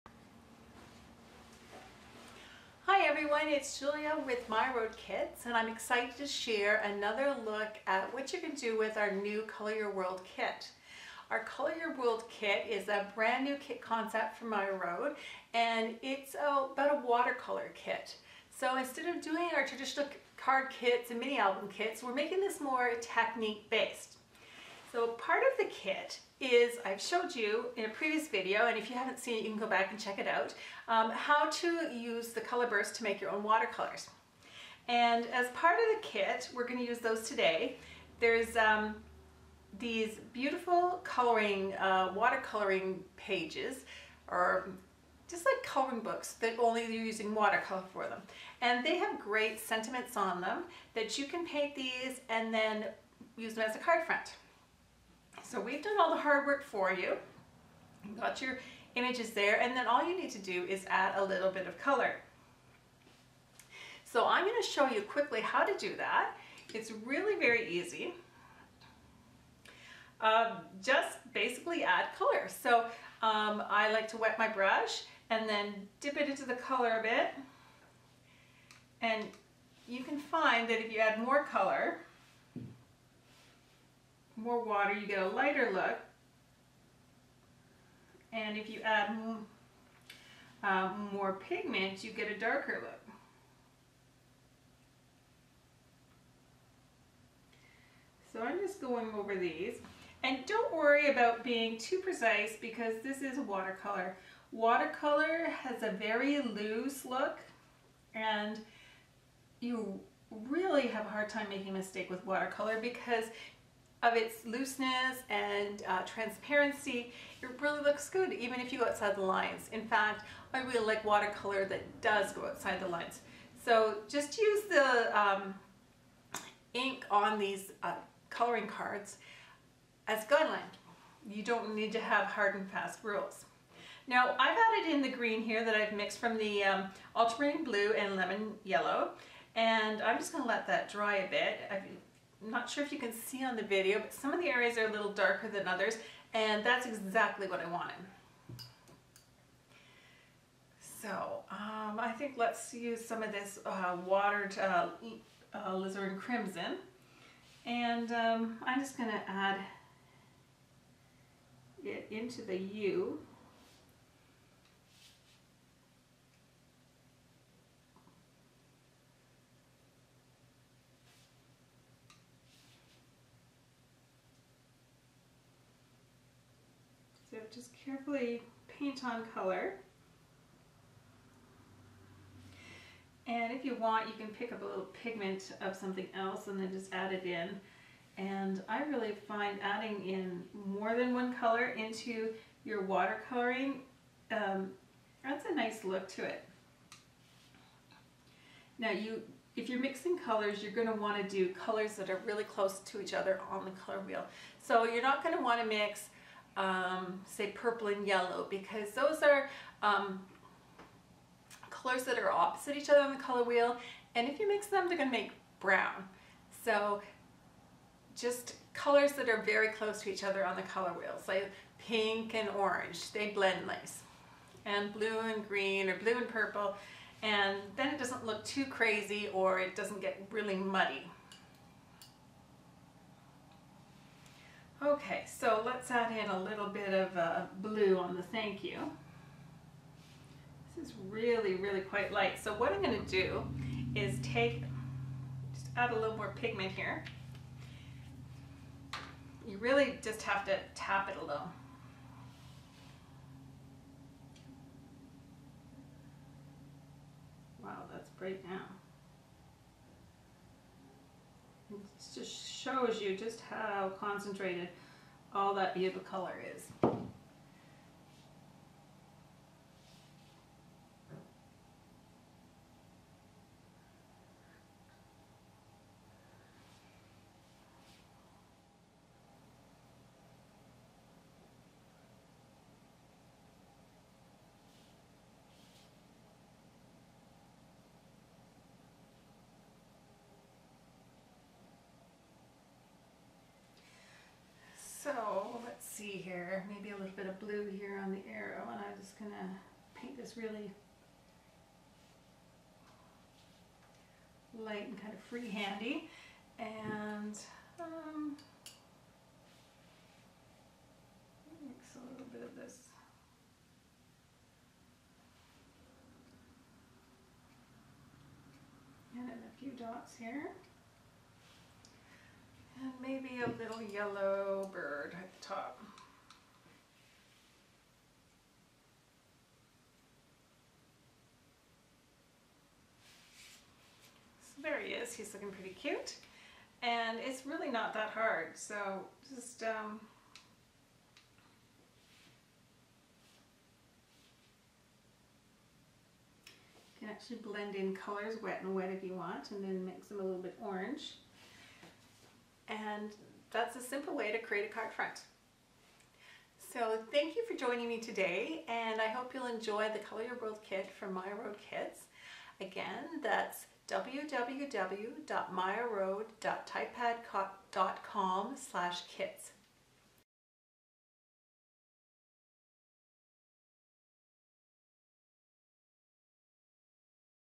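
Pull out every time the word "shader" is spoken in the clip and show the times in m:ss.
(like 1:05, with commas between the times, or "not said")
not said.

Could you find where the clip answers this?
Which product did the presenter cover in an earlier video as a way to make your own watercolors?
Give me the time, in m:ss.
0:32.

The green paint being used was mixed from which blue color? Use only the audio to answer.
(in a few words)
ultramarine blue.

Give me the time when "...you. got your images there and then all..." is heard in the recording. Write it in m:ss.
0:56.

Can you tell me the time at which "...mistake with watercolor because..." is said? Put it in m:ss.
1:51.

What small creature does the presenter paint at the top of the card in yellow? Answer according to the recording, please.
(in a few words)
bird.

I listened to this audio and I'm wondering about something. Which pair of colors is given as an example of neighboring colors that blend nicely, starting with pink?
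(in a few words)
pink and orange.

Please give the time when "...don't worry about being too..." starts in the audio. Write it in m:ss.
1:40.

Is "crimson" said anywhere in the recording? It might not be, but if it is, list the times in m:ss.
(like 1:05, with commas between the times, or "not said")
2:36.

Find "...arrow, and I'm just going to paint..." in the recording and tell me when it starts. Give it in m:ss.
4:58.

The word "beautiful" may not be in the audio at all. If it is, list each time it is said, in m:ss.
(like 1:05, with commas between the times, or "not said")
0:40, 4:25.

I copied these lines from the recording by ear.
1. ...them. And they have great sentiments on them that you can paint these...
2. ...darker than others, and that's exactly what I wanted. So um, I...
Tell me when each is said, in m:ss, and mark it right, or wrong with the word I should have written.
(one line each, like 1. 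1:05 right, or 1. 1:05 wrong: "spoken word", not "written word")
1. 0:48 right
2. 2:25 right.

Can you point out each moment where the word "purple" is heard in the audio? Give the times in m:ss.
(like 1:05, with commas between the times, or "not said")
3:27, 3:46.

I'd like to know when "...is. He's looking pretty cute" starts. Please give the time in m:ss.
5:34.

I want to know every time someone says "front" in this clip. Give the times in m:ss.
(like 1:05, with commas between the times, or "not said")
0:54, 5:54.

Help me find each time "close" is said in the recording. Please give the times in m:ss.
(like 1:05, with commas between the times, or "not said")
3:22, 3:39.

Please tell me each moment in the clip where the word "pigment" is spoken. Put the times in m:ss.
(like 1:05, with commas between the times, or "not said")
1:31, 3:05, 4:06.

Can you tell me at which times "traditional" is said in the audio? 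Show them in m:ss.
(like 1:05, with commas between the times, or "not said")
0:19.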